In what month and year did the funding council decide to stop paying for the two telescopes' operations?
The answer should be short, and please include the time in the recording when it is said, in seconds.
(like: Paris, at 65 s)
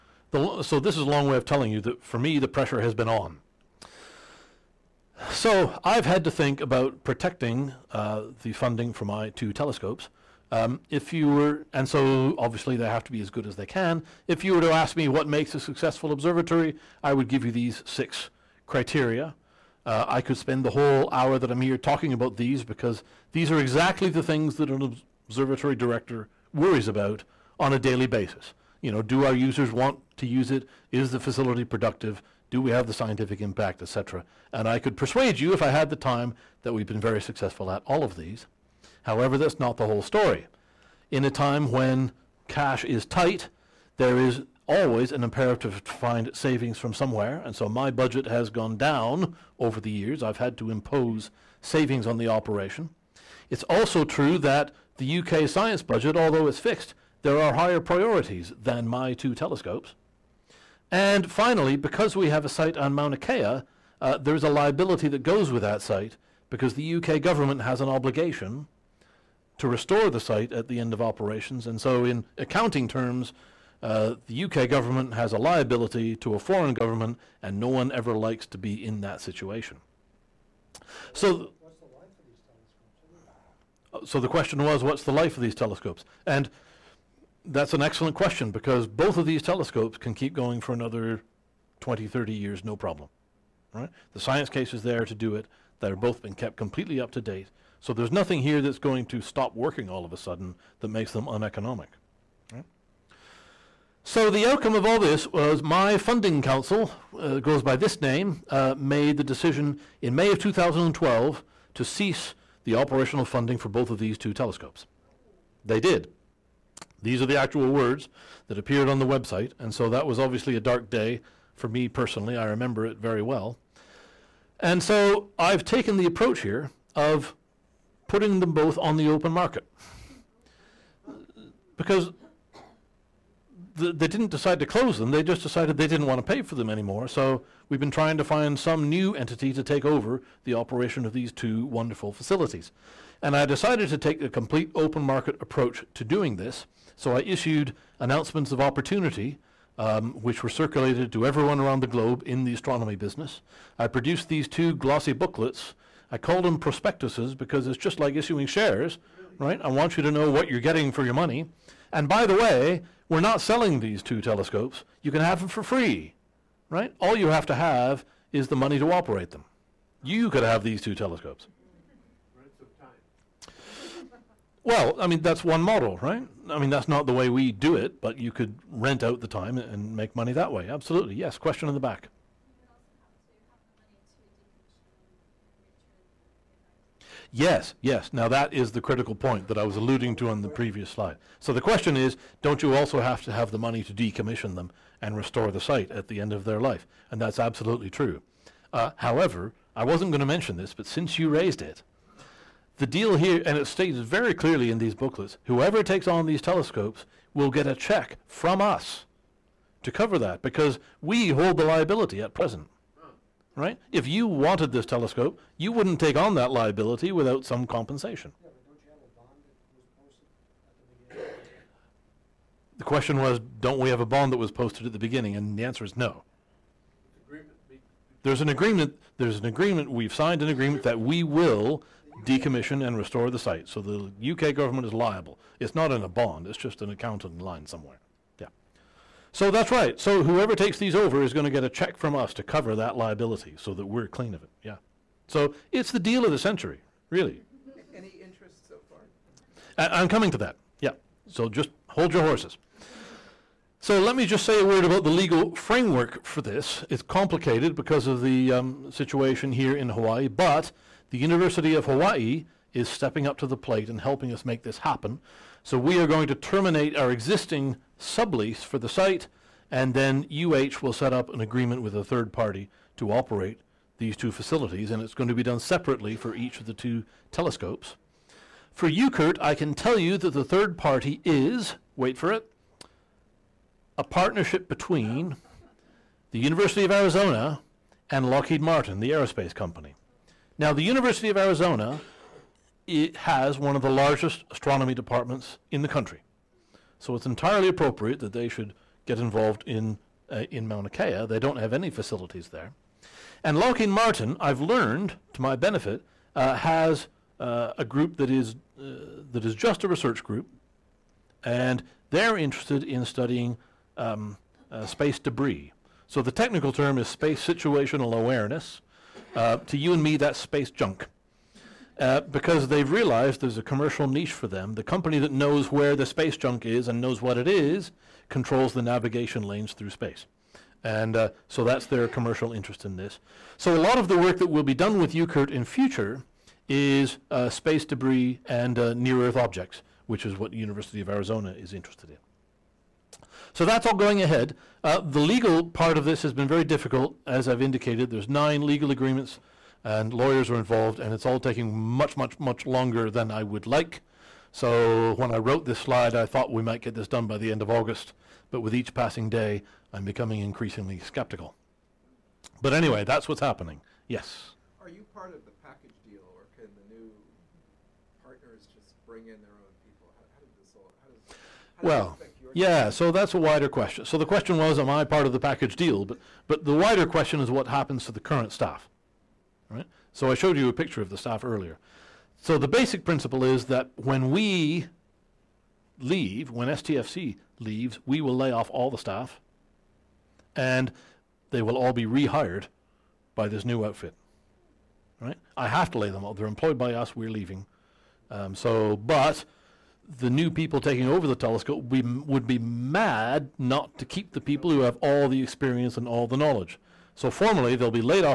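May 2012, at 110 s.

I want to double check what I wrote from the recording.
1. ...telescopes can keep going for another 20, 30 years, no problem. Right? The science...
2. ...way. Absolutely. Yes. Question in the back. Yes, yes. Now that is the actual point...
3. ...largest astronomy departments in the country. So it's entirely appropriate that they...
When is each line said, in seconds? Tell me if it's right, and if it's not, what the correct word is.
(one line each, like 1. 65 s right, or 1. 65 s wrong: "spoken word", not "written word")
1. 89 s right
2. 180 s wrong: "critical", not "actual"
3. 293 s right.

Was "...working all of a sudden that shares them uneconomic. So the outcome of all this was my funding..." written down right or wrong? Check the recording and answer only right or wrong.
wrong.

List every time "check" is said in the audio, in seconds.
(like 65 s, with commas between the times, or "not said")
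207 s, 241 s.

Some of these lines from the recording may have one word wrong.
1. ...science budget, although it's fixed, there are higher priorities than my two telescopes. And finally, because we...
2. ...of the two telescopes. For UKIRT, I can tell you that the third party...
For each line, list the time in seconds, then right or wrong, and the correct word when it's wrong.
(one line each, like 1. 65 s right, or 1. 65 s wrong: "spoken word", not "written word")
1. 55 s right
2. 276 s right.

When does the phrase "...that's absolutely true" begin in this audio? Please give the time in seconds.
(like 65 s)
197 s.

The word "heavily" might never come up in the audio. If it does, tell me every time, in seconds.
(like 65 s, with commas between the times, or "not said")
not said.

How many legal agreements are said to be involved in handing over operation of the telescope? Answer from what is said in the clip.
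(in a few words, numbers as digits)
9.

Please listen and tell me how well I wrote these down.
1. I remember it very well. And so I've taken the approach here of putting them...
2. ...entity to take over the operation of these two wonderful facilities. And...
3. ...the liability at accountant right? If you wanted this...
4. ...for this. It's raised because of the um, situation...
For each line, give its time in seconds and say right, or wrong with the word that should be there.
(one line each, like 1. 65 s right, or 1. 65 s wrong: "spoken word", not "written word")
1. 122 s right
2. 139 s right
3. 211 s wrong: "present", not "accountant"
4. 256 s wrong: "complicated", not "raised".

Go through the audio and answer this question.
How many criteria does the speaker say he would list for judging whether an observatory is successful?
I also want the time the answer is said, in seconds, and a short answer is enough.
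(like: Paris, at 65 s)
6, at 17 s.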